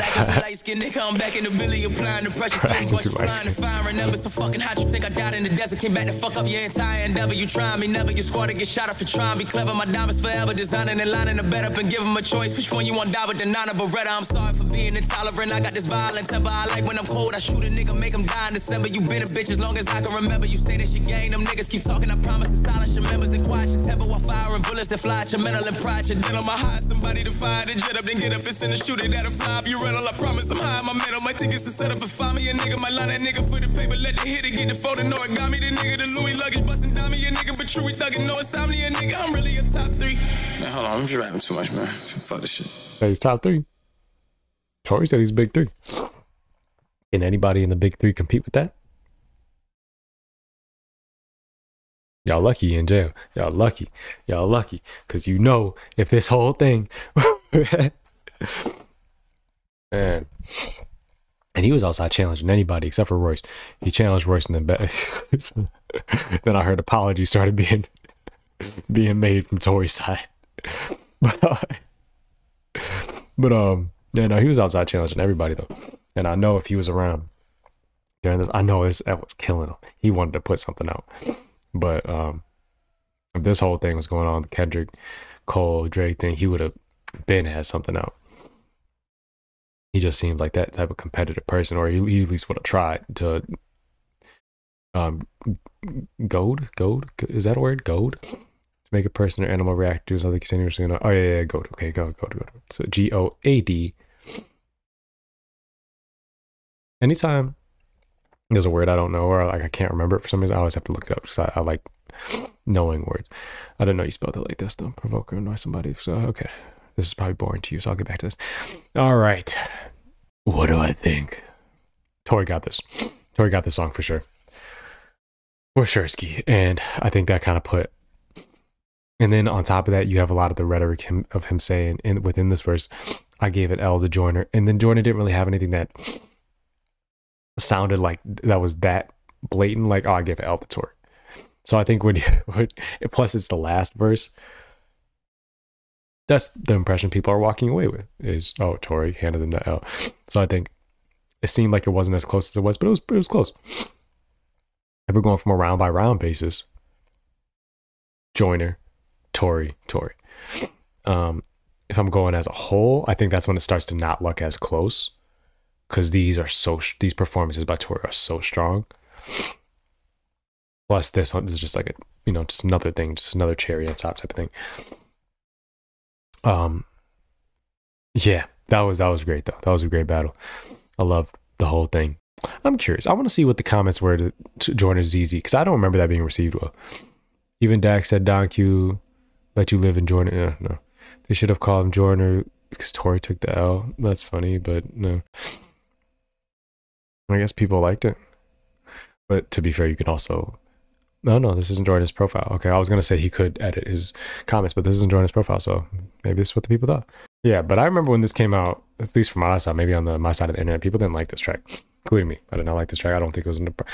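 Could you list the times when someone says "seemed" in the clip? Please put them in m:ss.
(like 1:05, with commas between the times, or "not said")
1:30, 2:31.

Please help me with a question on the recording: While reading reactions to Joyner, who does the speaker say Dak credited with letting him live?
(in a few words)
Don Q.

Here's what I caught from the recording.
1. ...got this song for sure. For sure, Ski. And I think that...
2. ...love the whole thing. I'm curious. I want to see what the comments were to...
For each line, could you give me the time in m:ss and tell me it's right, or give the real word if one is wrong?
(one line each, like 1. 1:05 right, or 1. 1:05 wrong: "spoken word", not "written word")
1. 2:03 right
2. 3:01 right.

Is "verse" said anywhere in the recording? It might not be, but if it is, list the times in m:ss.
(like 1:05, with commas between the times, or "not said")
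2:12, 2:23.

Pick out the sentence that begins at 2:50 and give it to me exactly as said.
Plus, this, this is just like a you know just another thing, just another cherry on top type of thing.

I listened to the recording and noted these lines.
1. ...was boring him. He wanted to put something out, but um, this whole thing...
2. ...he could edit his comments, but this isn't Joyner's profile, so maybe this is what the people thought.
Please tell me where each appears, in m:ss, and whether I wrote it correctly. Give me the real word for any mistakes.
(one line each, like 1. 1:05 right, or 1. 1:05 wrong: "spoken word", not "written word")
1. 1:19 wrong: "killing", not "boring"
2. 3:23 right.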